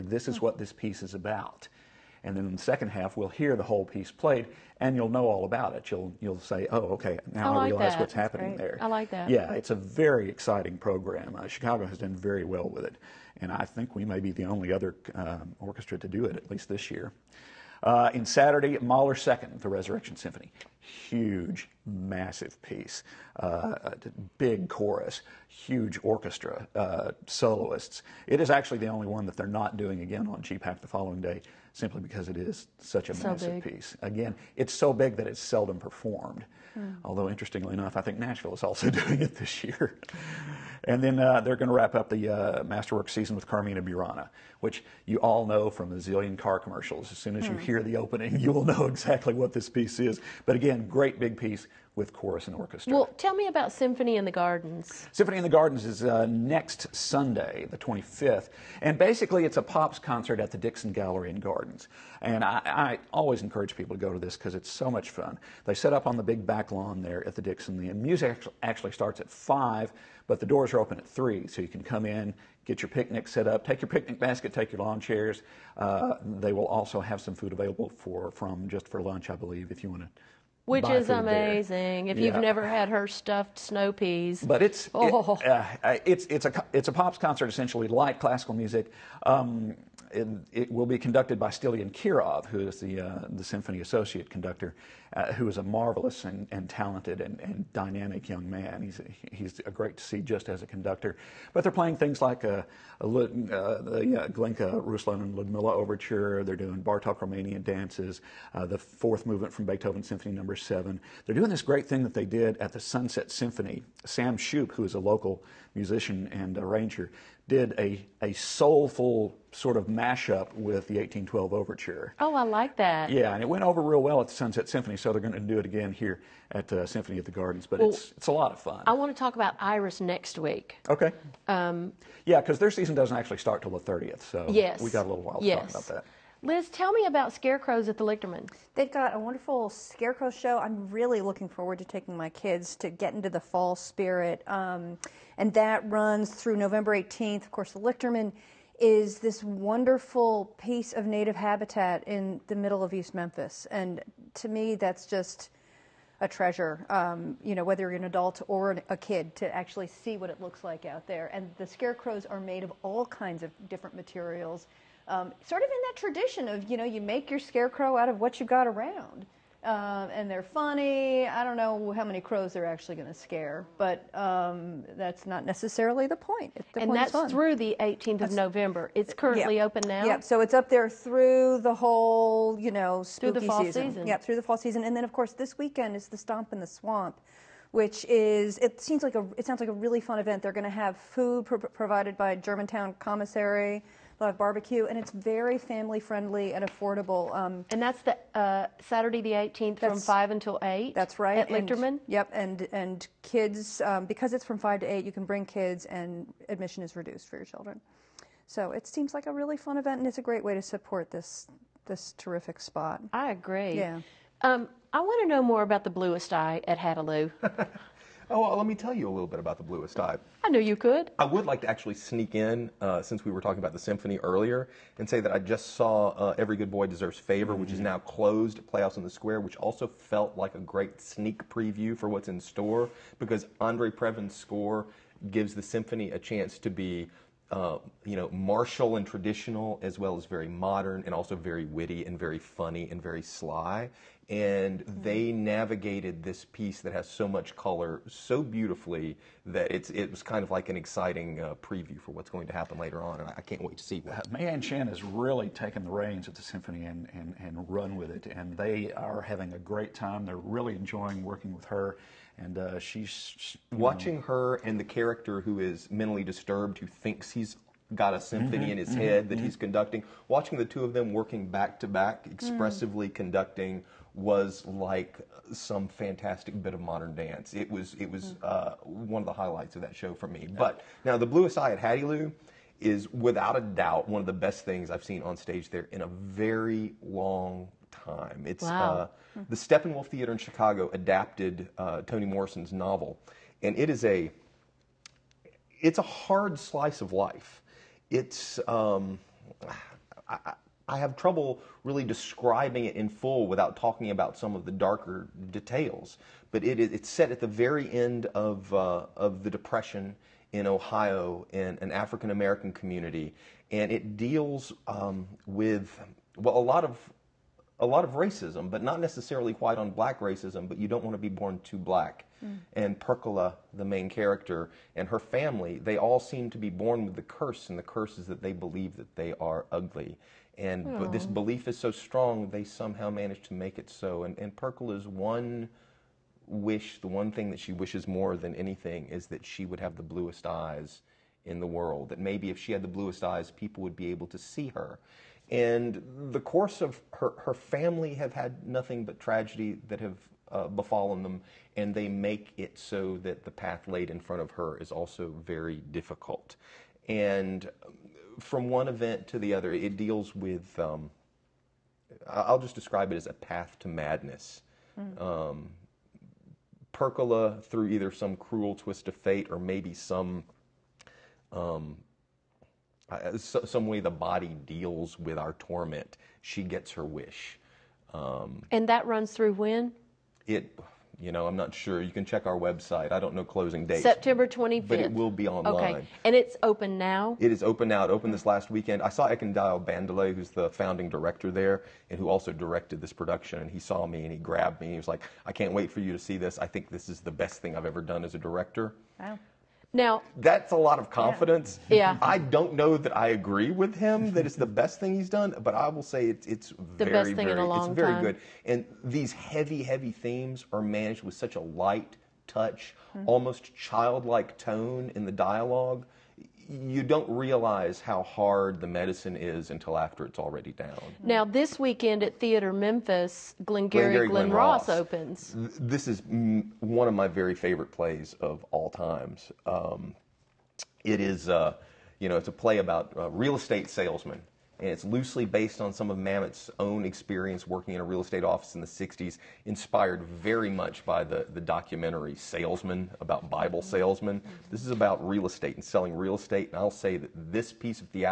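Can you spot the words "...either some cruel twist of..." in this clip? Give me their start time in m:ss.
6:07.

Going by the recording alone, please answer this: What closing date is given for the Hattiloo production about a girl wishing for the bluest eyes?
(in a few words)
September 25.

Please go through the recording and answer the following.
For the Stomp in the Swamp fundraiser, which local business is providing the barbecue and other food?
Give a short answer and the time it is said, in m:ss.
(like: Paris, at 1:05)
Germantown Commissary, at 3:12.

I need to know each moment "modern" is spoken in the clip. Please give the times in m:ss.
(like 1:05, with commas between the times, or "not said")
4:00, 4:36.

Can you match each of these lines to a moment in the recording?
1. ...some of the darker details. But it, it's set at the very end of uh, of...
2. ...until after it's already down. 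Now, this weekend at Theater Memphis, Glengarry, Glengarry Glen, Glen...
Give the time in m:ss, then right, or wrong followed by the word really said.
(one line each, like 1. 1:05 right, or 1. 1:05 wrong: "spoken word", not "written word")
1. 5:04 right
2. 6:59 right.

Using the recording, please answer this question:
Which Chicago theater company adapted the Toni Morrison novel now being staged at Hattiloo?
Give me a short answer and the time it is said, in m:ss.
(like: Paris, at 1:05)
Steppenwolf Theater, at 4:49.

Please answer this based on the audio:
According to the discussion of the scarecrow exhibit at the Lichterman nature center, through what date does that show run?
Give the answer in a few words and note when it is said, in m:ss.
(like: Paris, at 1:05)
November 18, at 2:26.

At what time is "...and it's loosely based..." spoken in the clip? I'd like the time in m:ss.
7:14.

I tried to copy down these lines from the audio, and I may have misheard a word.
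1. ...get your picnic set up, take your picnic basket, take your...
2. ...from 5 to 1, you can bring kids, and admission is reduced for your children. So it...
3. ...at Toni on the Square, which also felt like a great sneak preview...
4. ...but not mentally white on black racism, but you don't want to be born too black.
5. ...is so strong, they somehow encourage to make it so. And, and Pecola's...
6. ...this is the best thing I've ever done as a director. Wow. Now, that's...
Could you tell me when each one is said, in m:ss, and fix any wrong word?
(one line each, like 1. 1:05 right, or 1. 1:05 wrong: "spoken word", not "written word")
1. 1:12 right
2. 3:24 wrong: "8", not "1"
3. 3:48 wrong: "Playhouse", not "Toni"
4. 5:18 wrong: "necessarily", not "mentally"
5. 5:31 wrong: "manage", not "encourage"
6. 6:36 right.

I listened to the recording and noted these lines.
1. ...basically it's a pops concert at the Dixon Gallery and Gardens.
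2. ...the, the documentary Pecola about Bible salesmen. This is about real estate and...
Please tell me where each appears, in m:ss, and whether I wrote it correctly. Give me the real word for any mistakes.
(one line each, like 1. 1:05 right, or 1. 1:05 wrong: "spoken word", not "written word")
1. 0:58 right
2. 7:21 wrong: "Salesman", not "Pecola".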